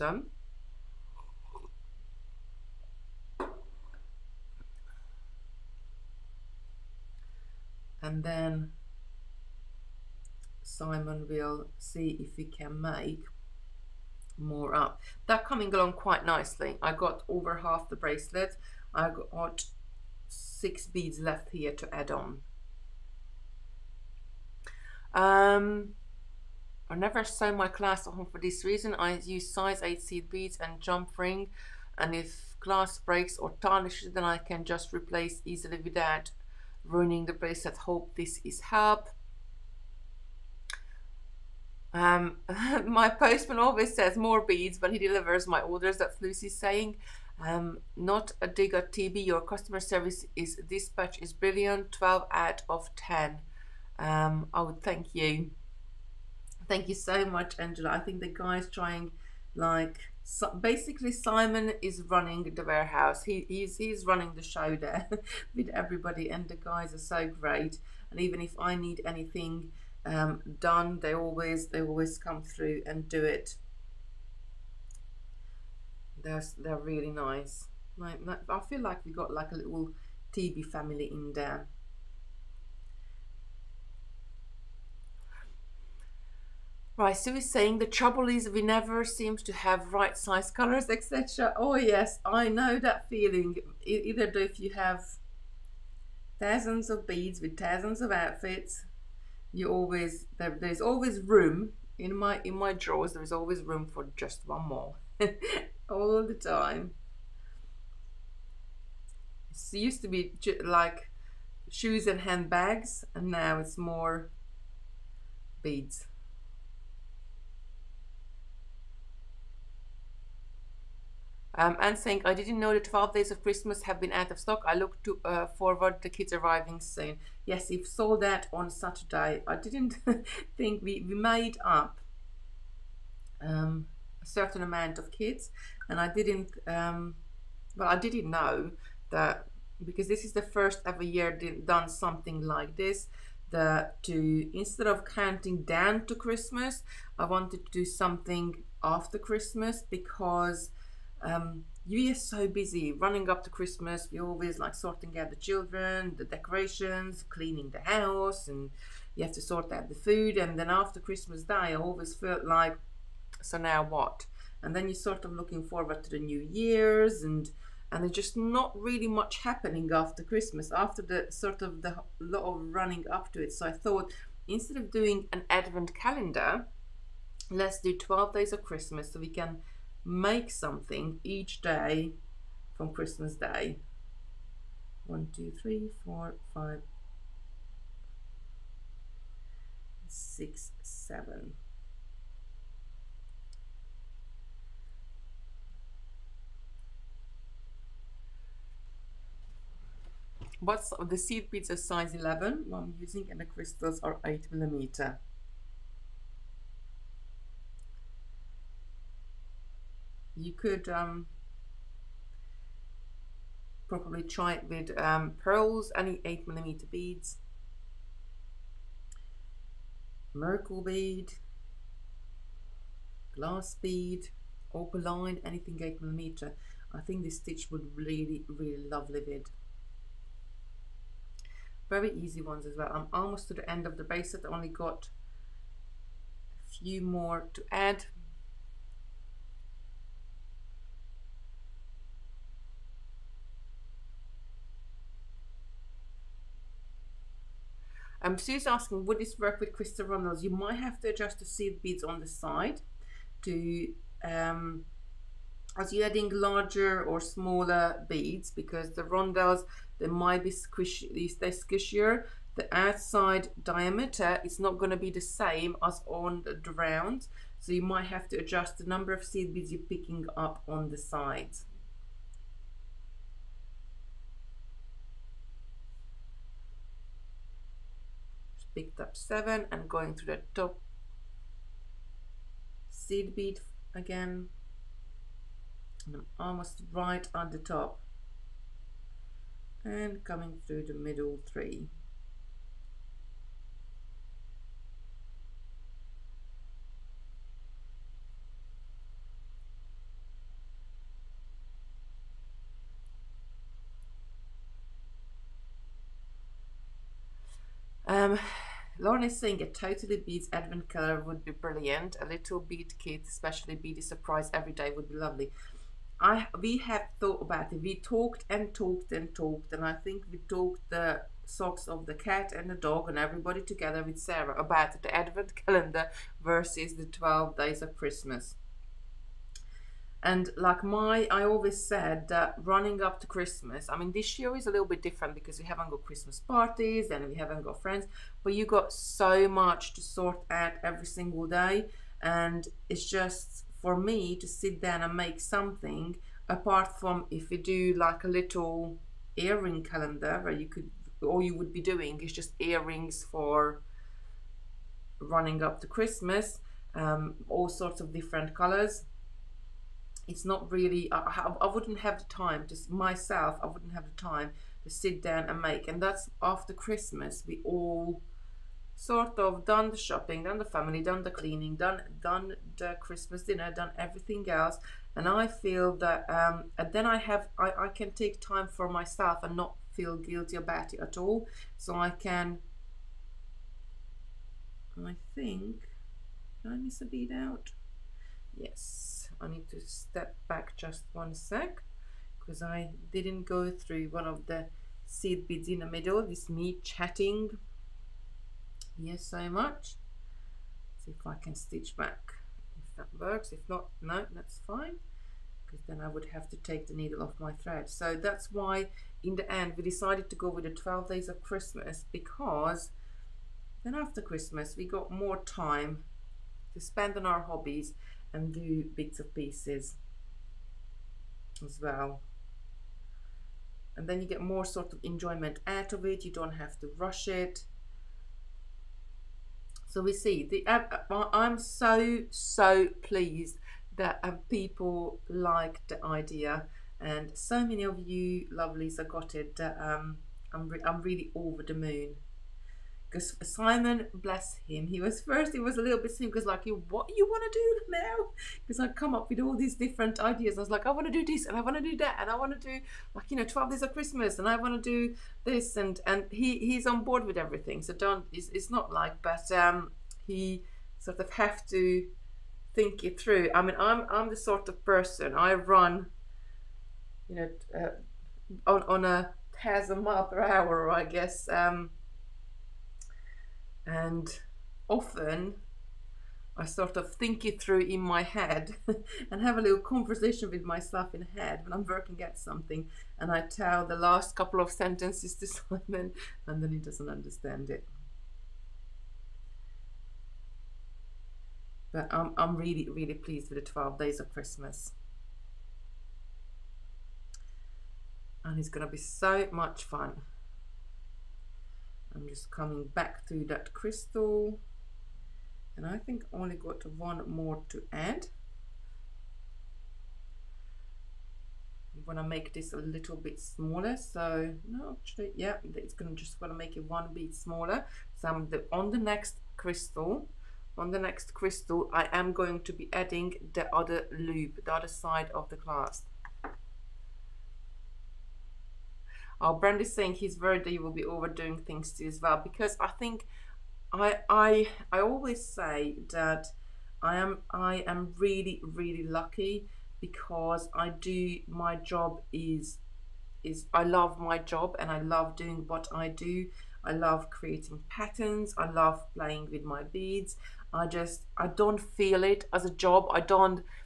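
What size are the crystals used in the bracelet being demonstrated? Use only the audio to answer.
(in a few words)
8 millimeter.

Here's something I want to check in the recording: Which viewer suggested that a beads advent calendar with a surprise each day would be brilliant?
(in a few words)
Lauren.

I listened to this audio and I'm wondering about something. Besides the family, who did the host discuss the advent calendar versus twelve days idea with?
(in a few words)
Sarah.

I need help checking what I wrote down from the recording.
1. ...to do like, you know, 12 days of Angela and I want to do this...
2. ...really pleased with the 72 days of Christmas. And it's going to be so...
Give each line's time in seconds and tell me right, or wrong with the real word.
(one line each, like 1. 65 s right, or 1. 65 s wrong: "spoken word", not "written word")
1. 452 s wrong: "Christmas", not "Angela"
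2. 492 s wrong: "12", not "72".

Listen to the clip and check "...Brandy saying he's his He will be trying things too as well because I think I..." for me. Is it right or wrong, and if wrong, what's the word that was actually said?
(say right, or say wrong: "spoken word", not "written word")
wrong: "overdoing", not "trying".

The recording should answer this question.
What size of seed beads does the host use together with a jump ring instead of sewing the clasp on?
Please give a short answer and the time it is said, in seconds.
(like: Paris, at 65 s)
8, at 29 s.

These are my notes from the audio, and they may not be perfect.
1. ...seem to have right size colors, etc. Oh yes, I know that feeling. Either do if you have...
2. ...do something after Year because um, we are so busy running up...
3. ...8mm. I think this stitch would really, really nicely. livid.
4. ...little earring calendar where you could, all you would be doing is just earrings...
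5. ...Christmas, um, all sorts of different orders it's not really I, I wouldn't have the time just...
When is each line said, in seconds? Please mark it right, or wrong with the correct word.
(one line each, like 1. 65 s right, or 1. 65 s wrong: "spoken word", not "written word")
1. 89 s right
2. 147 s wrong: "Christmas", not "Year"
3. 225 s wrong: "lovely", not "nicely"
4. 348 s right
5. 355 s wrong: "colors", not "orders".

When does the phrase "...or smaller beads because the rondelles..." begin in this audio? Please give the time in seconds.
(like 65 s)
257 s.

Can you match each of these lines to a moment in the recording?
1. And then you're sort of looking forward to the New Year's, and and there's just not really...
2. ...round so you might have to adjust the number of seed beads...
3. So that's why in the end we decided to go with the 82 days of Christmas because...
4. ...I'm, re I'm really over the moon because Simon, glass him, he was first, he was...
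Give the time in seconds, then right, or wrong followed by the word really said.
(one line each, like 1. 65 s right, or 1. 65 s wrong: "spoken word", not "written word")
1. 164 s right
2. 266 s right
3. 407 s wrong: "12", not "82"
4. 440 s wrong: "bless", not "glass".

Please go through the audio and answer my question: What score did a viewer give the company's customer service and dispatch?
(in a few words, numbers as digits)
12.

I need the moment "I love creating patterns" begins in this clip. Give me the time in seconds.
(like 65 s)
546 s.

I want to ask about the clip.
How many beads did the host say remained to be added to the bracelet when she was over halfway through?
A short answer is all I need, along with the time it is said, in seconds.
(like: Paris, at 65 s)
6, at 20 s.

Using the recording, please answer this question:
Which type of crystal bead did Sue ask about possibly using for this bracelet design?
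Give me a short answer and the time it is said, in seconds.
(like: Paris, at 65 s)
crystal rondelles, at 249 s.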